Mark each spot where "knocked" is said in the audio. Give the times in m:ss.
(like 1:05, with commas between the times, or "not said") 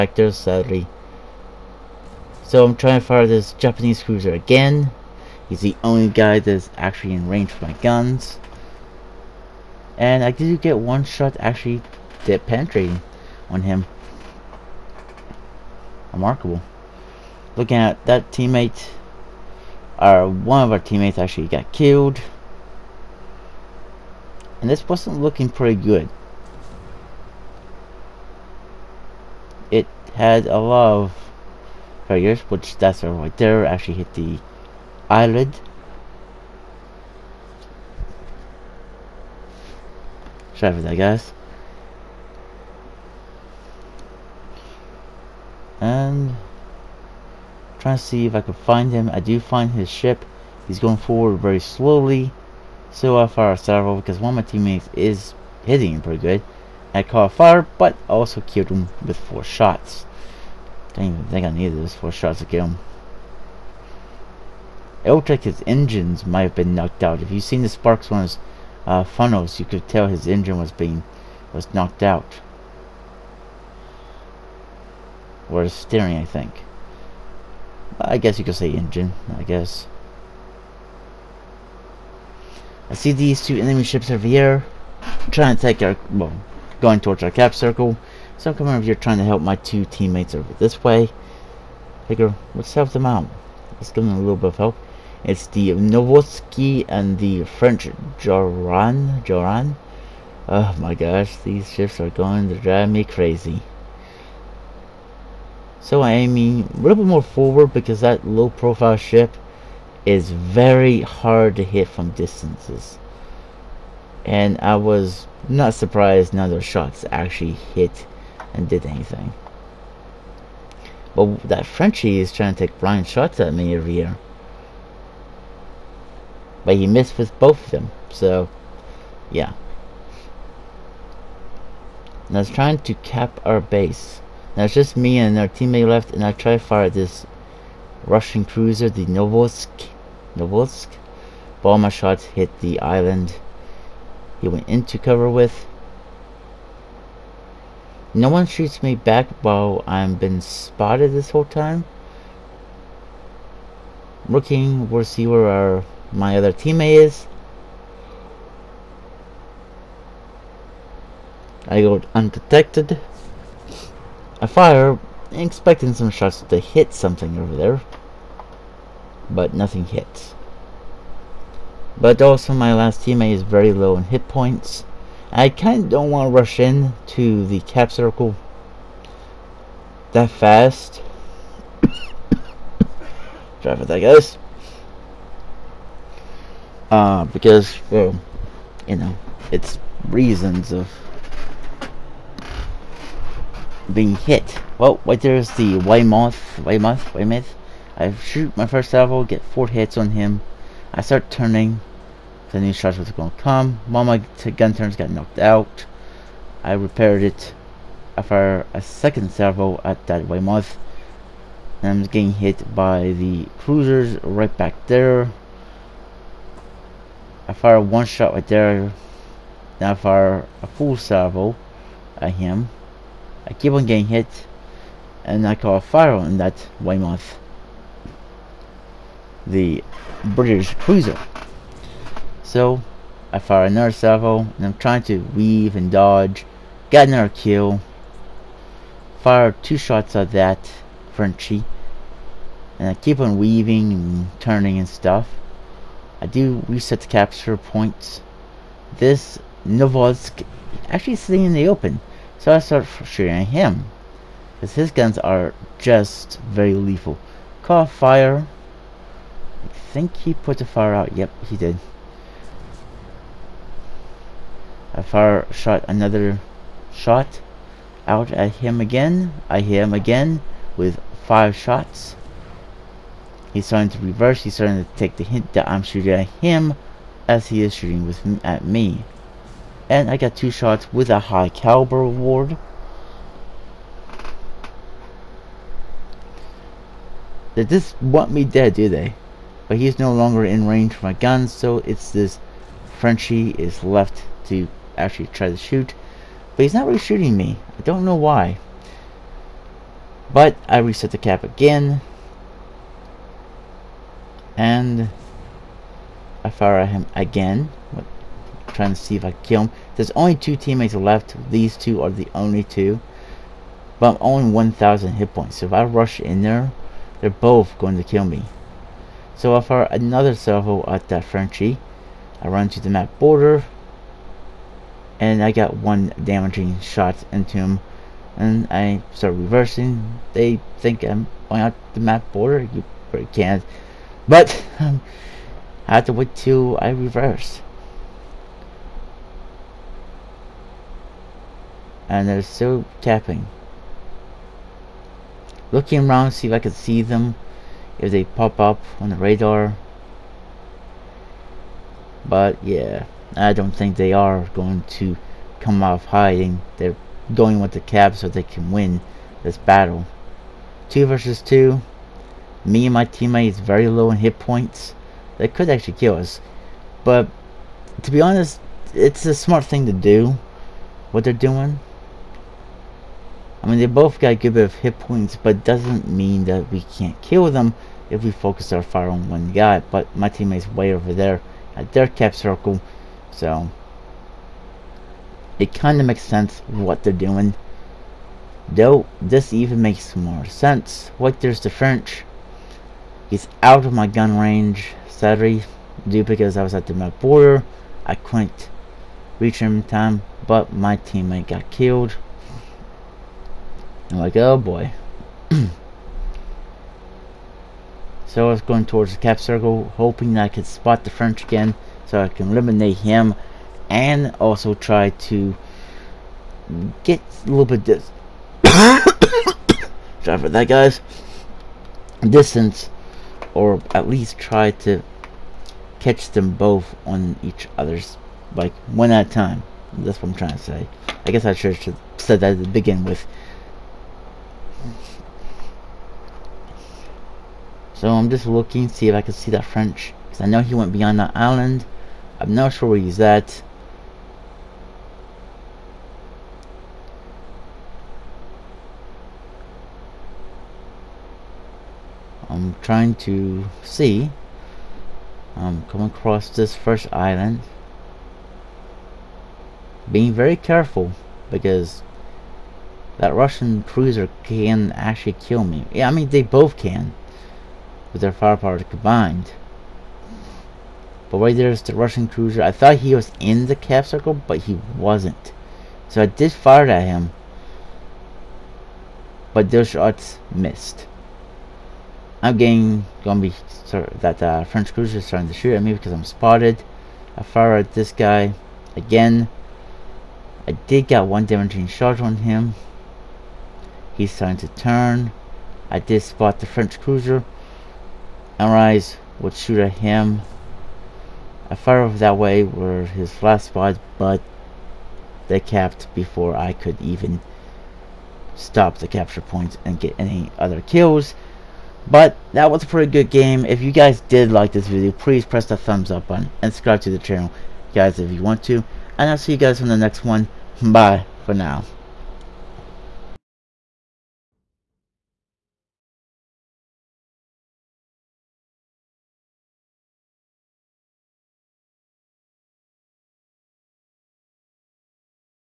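1:06, 1:11, 3:25.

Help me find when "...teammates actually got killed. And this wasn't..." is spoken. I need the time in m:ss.
0:20.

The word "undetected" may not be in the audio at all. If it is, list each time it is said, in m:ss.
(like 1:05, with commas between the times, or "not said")
2:42.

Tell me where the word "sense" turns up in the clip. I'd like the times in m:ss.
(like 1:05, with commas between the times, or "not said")
6:26, 6:30.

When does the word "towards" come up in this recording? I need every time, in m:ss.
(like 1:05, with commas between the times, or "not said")
1:27, 6:48.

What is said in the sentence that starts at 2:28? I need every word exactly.
No one shoots me back while I've been spotted this whole time.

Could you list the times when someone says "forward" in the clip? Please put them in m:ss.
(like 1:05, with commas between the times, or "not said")
0:50, 1:47.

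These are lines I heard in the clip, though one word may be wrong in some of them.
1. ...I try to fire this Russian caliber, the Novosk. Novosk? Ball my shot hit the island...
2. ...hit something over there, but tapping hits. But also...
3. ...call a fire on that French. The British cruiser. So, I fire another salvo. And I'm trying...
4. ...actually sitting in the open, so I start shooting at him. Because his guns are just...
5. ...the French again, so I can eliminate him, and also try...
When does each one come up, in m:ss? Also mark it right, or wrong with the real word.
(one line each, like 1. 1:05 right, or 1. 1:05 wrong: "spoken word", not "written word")
1. 2:16 wrong: "cruiser", not "caliber"
2. 2:46 wrong: "nothing", not "tapping"
3. 3:45 wrong: "Weymouth", not "French"
4. 4:10 right
5. 6:51 right.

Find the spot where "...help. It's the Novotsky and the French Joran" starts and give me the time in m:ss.
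1:34.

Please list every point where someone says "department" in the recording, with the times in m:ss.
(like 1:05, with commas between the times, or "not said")
not said.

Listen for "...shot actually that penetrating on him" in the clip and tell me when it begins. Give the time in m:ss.
0:11.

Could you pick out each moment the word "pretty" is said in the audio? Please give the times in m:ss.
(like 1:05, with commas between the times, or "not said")
0:25, 0:56, 8:32.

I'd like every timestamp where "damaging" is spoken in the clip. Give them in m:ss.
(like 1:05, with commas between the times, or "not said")
5:26, 8:11.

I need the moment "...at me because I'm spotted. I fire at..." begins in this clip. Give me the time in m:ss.
8:05.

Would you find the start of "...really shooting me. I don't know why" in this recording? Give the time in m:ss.
4:56.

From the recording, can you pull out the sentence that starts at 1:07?
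If you've seen the sparks on his uh, funnels.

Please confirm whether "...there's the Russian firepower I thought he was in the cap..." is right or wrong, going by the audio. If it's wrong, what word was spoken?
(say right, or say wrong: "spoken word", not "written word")
wrong: "cruiser", not "firepower".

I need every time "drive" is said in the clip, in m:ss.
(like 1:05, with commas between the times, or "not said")
1:42, 3:03.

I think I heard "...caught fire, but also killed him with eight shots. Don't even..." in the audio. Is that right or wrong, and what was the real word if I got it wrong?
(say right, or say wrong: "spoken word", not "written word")
wrong: "four", not "eight".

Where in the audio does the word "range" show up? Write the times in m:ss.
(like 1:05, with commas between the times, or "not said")
0:07, 4:50, 6:34.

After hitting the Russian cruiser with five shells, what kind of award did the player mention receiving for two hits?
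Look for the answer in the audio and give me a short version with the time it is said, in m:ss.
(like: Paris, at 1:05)
high caliber, at 4:41.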